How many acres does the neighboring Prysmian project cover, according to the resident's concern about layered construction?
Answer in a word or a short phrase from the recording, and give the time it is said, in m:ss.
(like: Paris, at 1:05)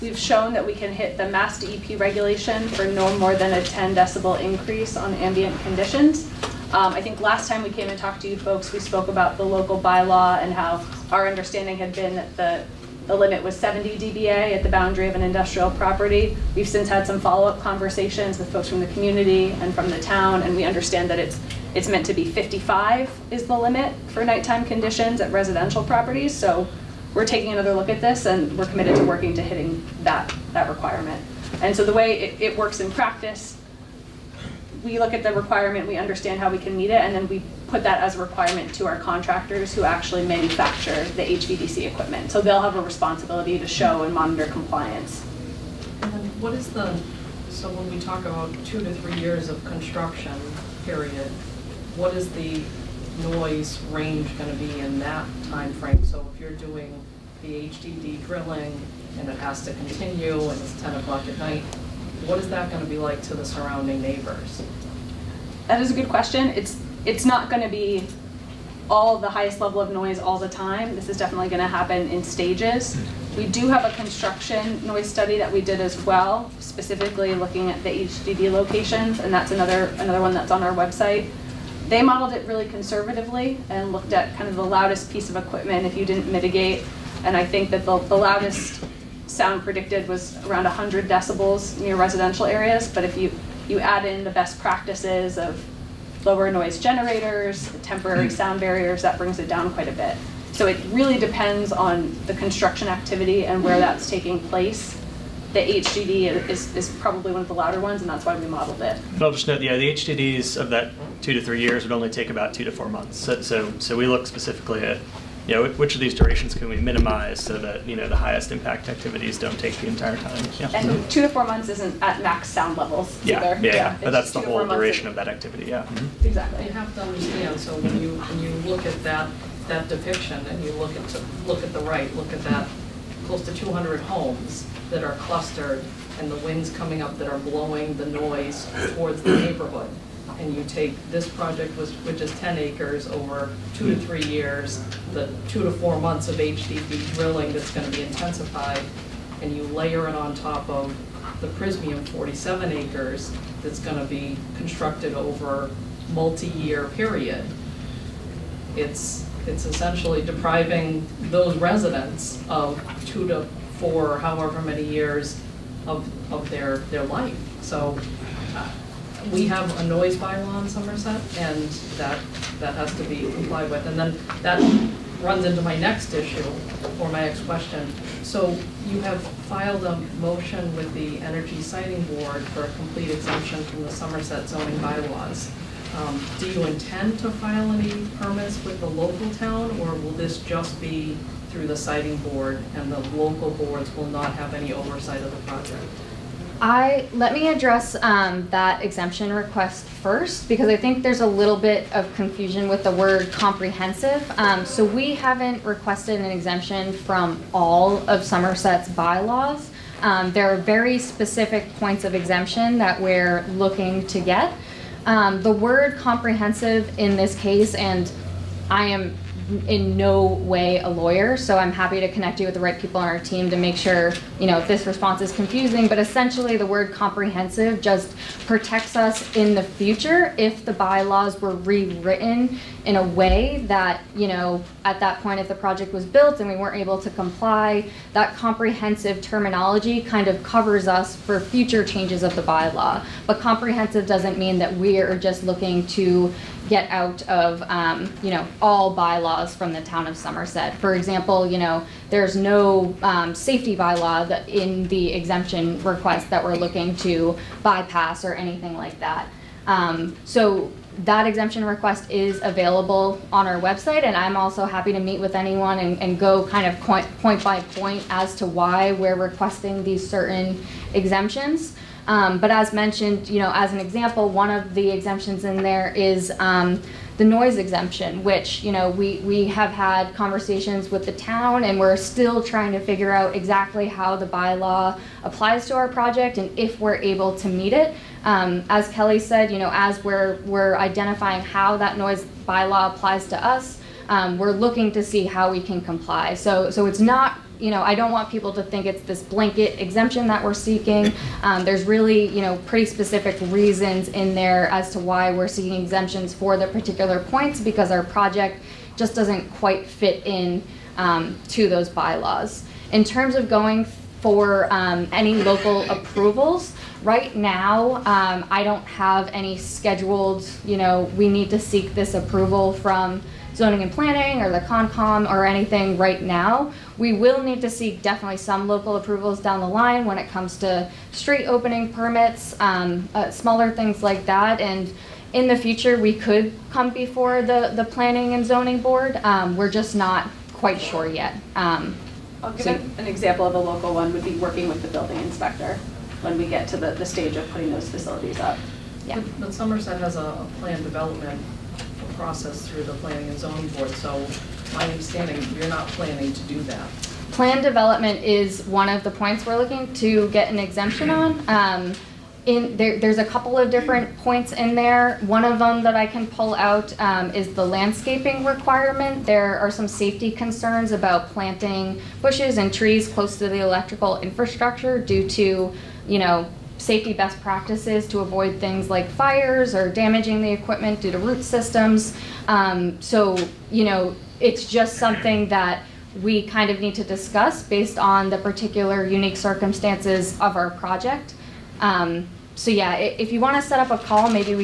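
47 acres, at 2:32.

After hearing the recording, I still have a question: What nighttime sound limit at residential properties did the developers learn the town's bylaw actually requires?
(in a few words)
55.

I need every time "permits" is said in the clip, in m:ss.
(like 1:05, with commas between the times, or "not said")
3:08, 5:31.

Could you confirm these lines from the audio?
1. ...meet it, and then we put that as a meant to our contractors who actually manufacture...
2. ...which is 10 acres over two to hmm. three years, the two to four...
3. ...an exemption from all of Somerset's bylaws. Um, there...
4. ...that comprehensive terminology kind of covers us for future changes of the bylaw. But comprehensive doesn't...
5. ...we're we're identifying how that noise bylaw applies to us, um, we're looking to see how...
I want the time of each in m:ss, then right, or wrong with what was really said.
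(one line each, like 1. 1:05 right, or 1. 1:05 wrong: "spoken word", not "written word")
1. 0:36 wrong: "requirement", not "meant"
2. 2:22 right
3. 3:26 right
4. 3:58 right
5. 4:50 right.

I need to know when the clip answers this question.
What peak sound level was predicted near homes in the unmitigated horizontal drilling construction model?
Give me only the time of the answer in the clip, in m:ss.
1:30.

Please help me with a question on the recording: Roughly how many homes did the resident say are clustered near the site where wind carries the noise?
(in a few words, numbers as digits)
200.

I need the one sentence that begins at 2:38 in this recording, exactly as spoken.
It's it's essentially depriving those residents of two to four, however many years of, of their, their life.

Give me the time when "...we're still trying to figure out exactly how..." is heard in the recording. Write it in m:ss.
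4:41.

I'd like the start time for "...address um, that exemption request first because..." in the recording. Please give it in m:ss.
3:17.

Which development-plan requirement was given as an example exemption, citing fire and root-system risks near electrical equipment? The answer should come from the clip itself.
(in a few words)
landscaping requirement.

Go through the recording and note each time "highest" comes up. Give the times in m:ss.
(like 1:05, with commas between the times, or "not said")
1:09, 1:58.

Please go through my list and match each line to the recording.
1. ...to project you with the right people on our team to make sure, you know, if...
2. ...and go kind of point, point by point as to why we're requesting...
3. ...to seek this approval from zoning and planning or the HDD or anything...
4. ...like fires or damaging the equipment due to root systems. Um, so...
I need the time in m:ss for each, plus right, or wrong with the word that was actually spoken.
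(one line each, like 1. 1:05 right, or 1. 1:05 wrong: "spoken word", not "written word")
1. 3:42 wrong: "connect", not "project"
2. 4:26 right
3. 5:21 wrong: "CONCOM", not "HDD"
4. 6:18 right.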